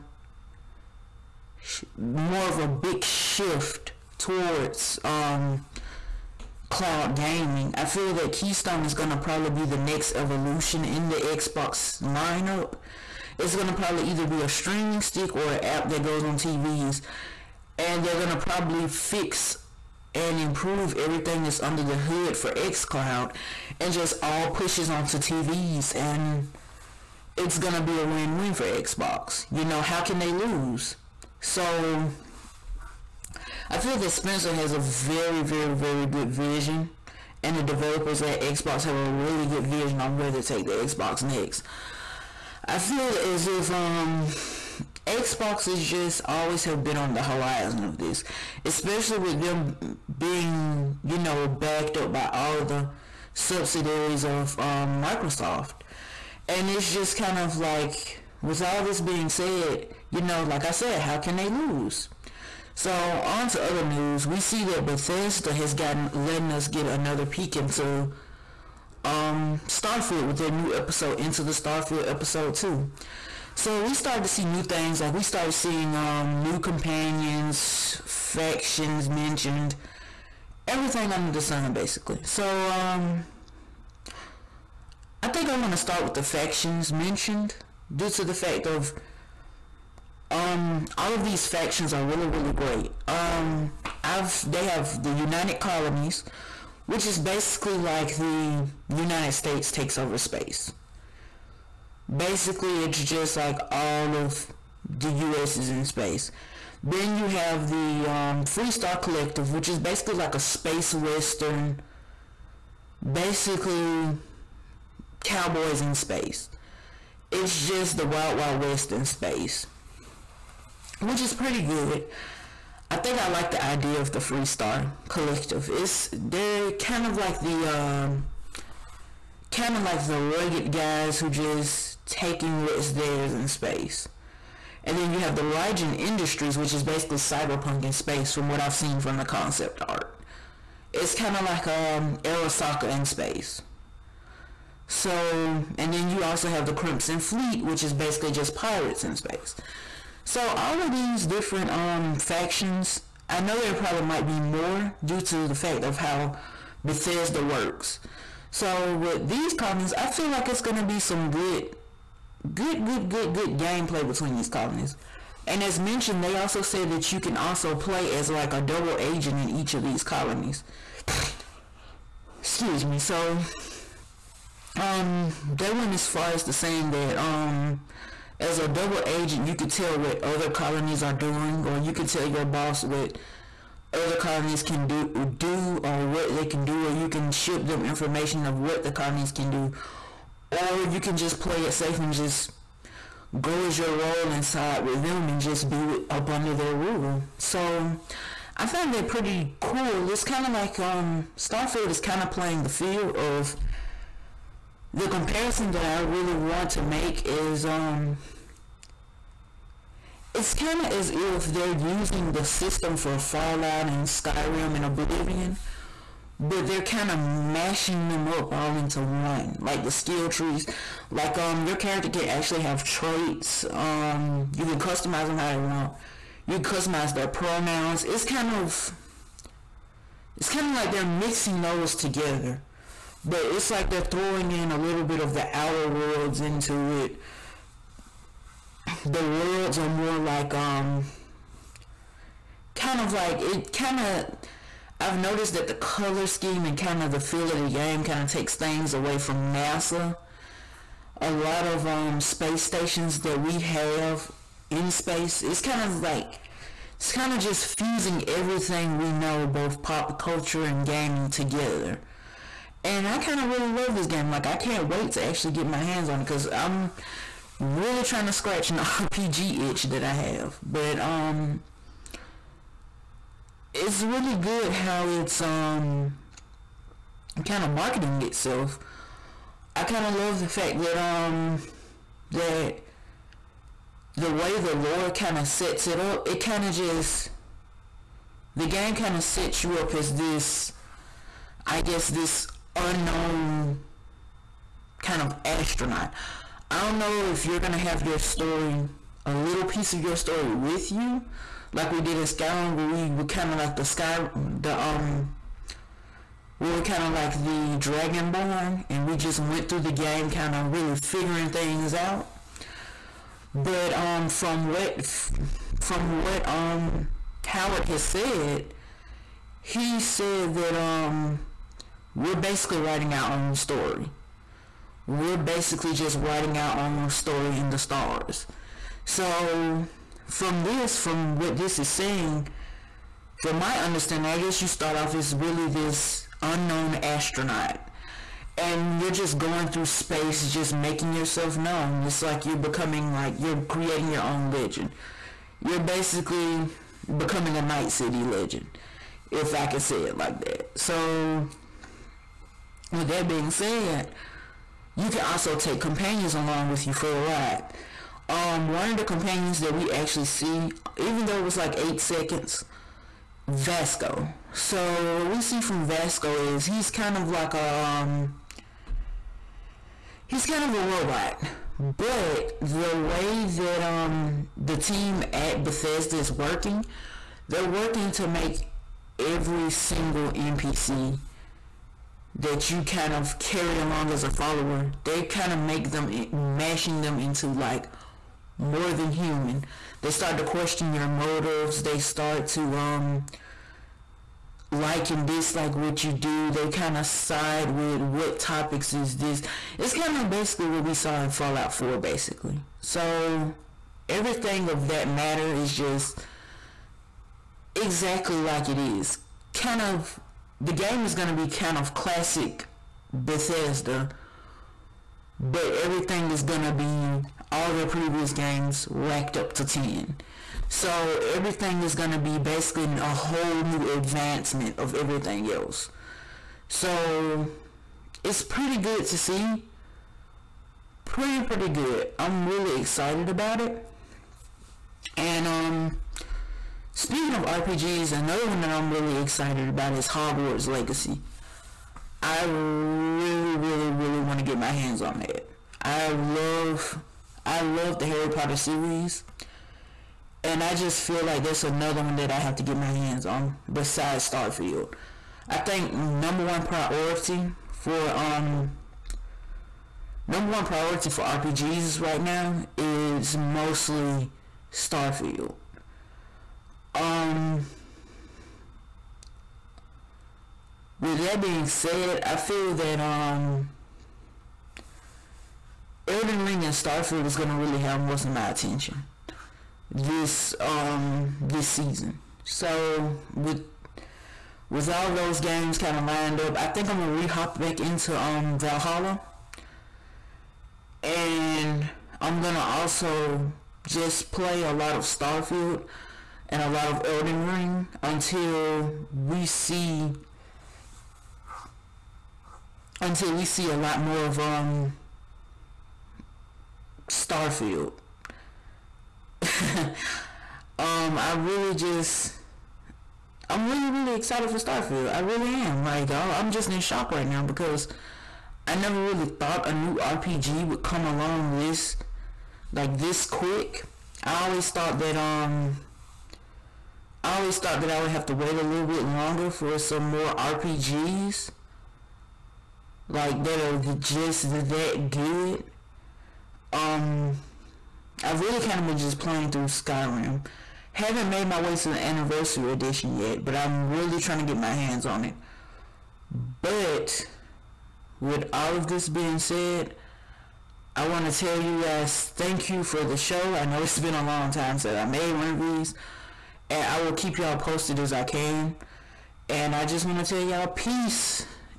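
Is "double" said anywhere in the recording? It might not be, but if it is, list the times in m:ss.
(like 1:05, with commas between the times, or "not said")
2:48, 2:58.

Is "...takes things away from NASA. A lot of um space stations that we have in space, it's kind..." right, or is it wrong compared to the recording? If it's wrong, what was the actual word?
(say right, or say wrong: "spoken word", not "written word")
right.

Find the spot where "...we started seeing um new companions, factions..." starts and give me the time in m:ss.
1:15.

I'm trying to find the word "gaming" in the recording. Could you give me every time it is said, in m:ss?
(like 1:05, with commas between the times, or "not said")
0:07, 4:20.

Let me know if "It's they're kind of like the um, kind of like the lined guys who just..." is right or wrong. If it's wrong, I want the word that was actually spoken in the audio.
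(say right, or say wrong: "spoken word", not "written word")
wrong: "rugged", not "lined".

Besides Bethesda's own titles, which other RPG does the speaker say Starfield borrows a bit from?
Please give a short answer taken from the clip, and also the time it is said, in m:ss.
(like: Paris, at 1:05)
The Outer Worlds, at 3:55.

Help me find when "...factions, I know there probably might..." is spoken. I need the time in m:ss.
2:32.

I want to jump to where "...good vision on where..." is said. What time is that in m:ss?
0:39.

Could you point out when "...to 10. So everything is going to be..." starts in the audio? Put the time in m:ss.
6:59.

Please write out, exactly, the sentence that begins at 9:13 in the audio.
I know it's been a long time since I made one of these.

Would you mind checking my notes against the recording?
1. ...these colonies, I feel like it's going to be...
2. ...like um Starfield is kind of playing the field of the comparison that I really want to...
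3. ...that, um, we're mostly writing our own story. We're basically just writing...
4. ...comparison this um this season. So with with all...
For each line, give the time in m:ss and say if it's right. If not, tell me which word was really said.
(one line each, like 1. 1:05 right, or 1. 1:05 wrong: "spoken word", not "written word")
1. 2:39 right
2. 3:20 right
3. 5:20 wrong: "basically", not "mostly"
4. 7:58 wrong: "attention", not "comparison".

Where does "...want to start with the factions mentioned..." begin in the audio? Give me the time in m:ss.
1:25.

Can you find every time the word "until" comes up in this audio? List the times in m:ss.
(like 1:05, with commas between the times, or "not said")
8:18, 8:23.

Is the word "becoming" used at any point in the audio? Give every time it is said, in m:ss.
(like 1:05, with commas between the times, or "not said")
5:42, 5:47.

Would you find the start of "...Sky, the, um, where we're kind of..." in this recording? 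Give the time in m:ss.
5:03.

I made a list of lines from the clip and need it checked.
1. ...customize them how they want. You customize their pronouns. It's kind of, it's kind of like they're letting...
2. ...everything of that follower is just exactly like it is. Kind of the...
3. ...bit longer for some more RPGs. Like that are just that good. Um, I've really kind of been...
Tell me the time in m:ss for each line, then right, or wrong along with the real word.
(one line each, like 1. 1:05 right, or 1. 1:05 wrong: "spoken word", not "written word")
1. 3:44 wrong: "mixing", not "letting"
2. 6:44 wrong: "matter", not "follower"
3. 8:48 right.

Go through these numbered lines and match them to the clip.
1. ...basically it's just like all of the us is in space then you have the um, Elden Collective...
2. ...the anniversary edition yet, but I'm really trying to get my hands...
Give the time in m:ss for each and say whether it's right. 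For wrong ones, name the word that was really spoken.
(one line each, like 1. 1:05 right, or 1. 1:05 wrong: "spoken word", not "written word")
1. 1:42 wrong: "Freestar", not "Elden"
2. 9:01 right.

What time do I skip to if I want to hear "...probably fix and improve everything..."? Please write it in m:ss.
0:18.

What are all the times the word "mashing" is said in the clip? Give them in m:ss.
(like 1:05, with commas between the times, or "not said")
3:37, 6:26.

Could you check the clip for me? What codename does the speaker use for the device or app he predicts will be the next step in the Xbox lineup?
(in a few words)
Keystone.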